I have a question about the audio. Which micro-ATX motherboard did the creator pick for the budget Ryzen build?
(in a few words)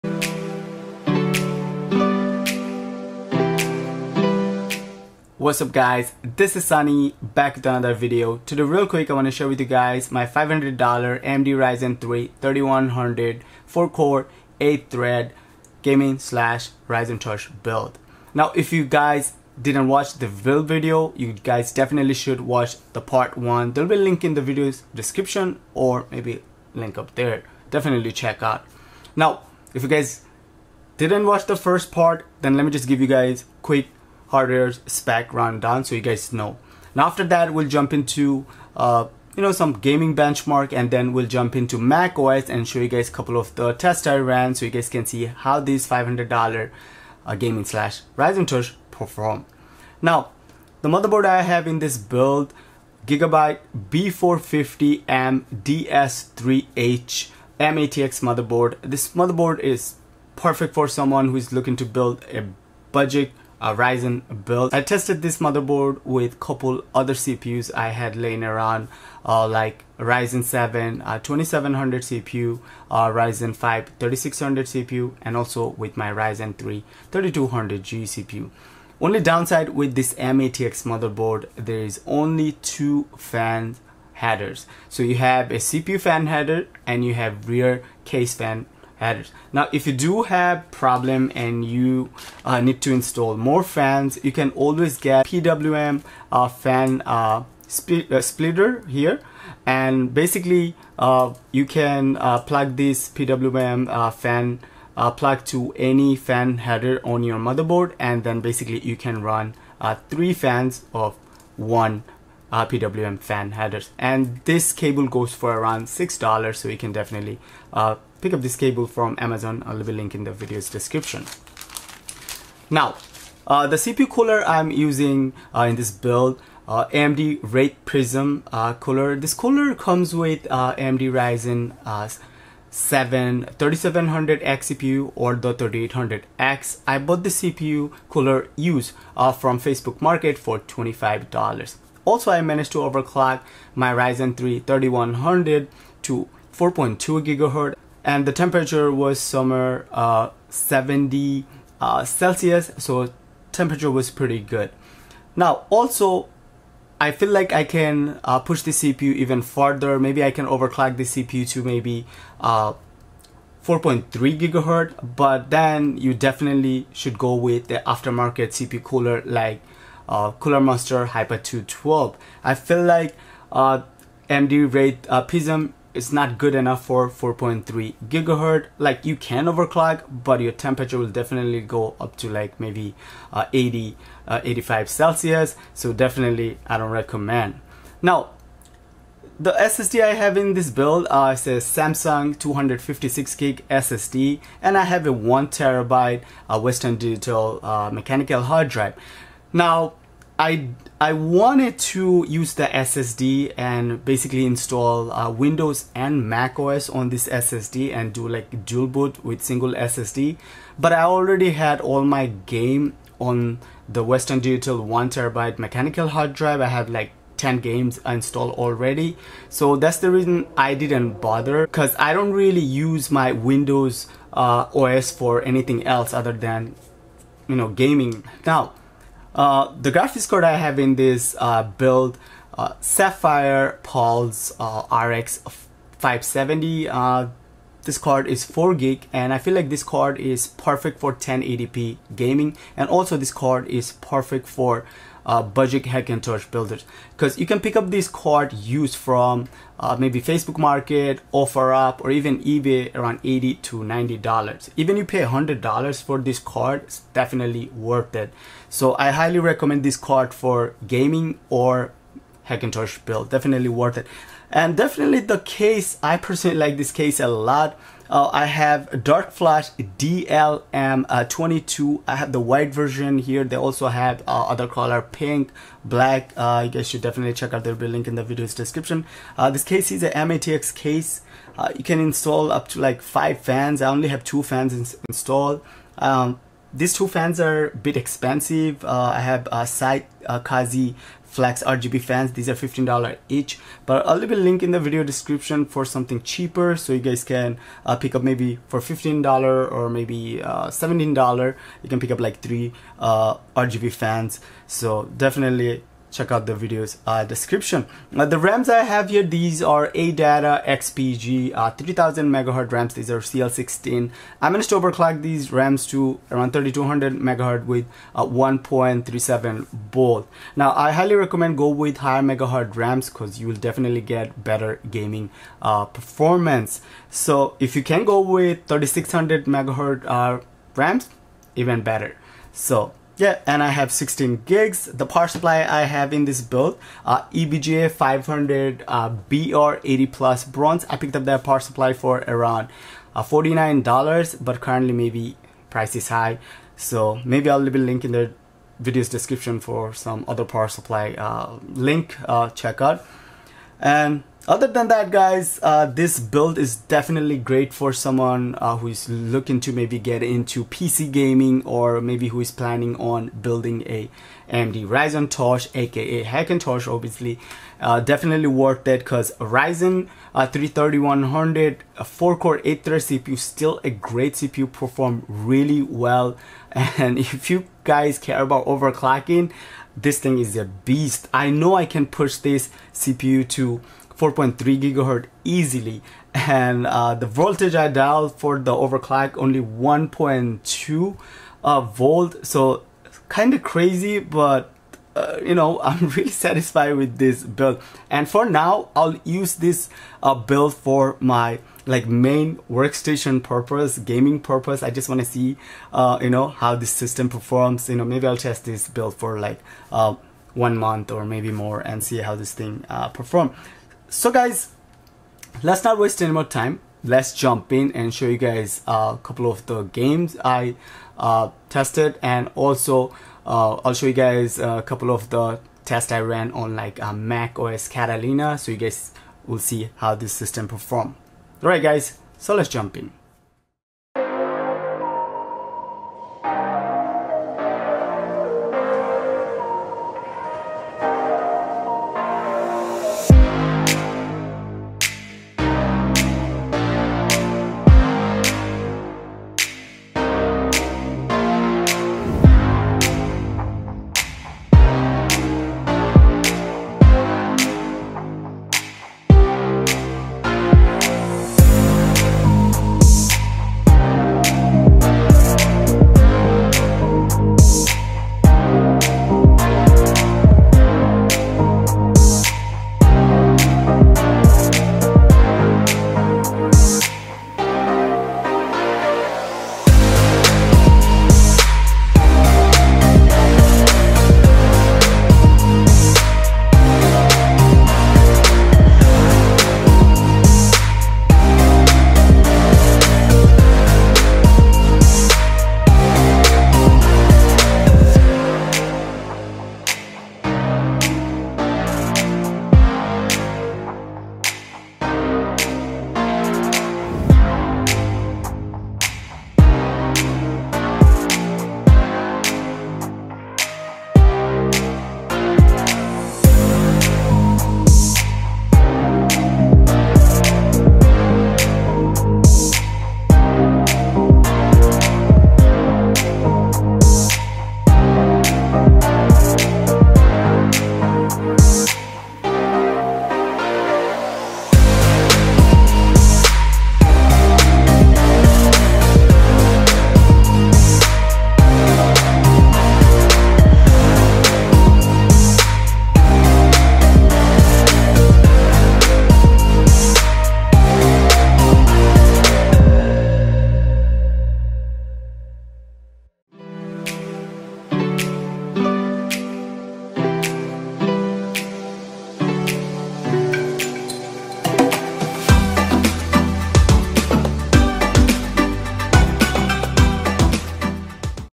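Gigabyte B450M DS3H.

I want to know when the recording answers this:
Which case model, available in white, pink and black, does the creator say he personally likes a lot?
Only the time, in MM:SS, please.
04:29.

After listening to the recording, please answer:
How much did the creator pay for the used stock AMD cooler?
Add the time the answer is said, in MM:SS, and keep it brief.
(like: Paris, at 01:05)
$25, at 02:20.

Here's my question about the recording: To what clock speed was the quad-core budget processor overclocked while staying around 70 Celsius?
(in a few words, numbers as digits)
4.2 GHz.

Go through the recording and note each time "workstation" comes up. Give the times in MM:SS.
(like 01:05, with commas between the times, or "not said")
06:42.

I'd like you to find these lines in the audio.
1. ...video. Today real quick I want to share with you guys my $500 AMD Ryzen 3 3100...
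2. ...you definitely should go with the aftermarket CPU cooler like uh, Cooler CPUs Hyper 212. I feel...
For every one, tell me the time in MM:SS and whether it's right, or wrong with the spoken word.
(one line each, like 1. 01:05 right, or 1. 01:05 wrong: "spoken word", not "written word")
1. 00:07 right
2. 02:45 wrong: "Master", not "CPUs".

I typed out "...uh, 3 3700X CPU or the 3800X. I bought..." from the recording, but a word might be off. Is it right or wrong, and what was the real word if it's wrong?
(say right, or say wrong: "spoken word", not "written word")
wrong: "7", not "3".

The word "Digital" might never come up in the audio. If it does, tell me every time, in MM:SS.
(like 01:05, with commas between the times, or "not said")
03:16, 03:34.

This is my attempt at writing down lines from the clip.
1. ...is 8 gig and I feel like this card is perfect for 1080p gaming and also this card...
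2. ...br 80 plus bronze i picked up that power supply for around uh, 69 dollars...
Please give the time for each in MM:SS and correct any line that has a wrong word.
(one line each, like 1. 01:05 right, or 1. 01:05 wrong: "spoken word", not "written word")
1. 03:58 wrong: "4", not "8"
2. 05:39 wrong: "49", not "69".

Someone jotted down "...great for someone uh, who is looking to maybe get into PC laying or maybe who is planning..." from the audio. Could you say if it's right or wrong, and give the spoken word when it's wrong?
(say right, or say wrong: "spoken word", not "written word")
wrong: "gaming", not "laying".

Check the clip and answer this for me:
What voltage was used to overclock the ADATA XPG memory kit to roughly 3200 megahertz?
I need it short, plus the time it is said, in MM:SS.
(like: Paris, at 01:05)
1.37 volts, at 05:18.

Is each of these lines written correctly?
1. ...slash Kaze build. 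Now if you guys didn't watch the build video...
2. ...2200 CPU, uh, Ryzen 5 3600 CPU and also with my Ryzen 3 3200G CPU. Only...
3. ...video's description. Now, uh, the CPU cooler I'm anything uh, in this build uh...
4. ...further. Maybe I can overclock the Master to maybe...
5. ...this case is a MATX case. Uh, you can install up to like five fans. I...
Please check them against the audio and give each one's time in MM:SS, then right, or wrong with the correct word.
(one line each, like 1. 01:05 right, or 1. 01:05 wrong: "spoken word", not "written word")
1. 00:16 wrong: "Ryzentosh", not "Kaze"
2. 01:11 wrong: "2700", not "2200"
3. 02:00 wrong: "using", not "anything"
4. 02:39 wrong: "CPU", not "Master"
5. 04:39 right.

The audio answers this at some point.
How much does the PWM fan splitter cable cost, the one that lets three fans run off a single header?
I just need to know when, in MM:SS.
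01:55.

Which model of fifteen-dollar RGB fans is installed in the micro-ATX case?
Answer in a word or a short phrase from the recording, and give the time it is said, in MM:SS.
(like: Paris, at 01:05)
Scythe Kaze Flex, at 04:49.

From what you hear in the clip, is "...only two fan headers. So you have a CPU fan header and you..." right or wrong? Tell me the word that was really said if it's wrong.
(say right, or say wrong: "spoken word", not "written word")
right.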